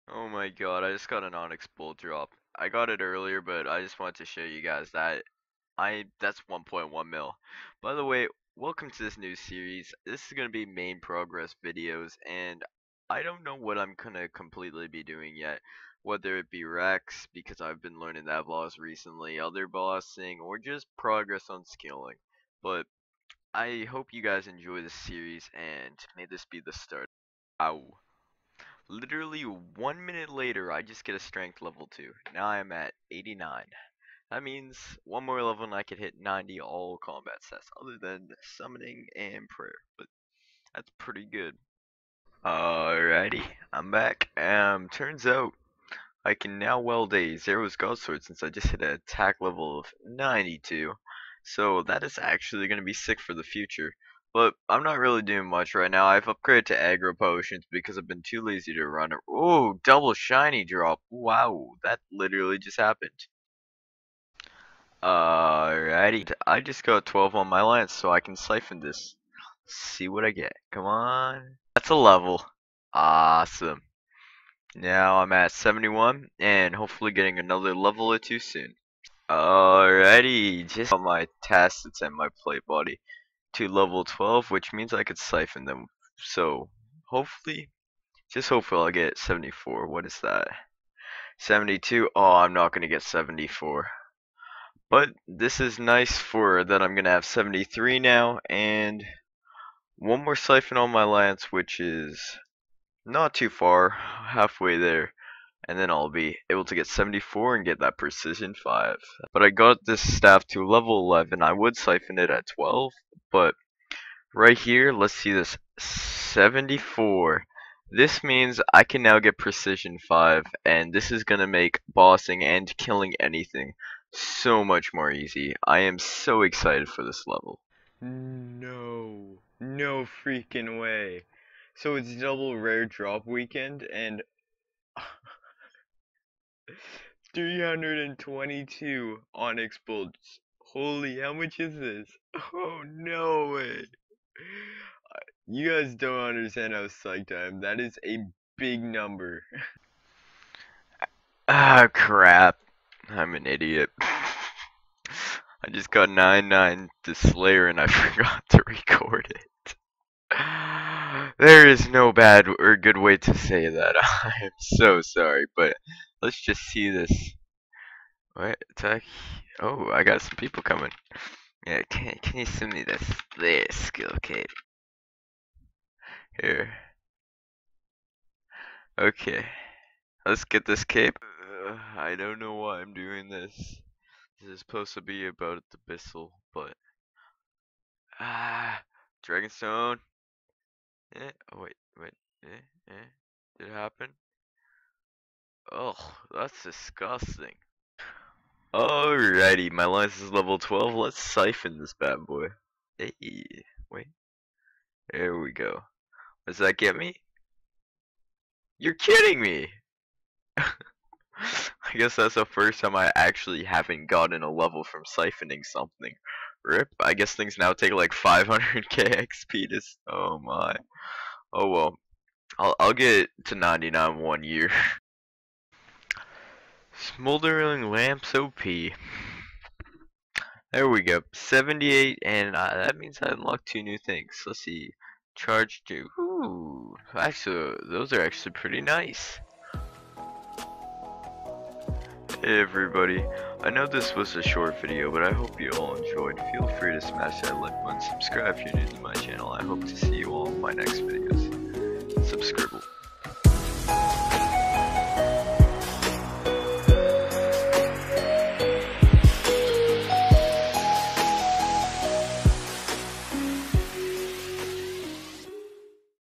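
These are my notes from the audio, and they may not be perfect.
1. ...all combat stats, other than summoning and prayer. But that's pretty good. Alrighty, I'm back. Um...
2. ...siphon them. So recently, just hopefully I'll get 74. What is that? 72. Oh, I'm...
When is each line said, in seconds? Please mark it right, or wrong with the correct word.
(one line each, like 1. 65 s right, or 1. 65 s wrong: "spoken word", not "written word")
1. 36 s right
2. 85 s wrong: "hopefully", not "recently".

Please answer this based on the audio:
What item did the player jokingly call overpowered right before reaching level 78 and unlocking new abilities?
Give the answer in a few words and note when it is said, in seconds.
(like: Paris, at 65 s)
Smoldering Lamps, at 227 s.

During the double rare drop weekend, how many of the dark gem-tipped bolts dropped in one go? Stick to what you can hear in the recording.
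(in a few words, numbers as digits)
322.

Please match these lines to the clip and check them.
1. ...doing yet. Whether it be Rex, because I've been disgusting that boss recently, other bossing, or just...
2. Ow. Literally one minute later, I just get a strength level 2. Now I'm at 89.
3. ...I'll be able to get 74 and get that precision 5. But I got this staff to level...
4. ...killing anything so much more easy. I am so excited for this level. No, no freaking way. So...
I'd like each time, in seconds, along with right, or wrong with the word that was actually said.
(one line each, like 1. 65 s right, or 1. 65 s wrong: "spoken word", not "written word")
1. 15 s wrong: "learning", not "disgusting"
2. 27 s right
3. 105 s right
4. 122 s right.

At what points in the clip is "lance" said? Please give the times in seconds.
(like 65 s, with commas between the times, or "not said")
67 s, 101 s, 199 s.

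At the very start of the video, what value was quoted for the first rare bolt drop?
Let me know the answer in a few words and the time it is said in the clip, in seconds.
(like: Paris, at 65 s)
1.1 mil, at 6 s.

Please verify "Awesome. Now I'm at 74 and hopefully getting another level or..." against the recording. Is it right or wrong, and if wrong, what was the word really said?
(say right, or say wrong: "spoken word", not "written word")
wrong: "71", not "74".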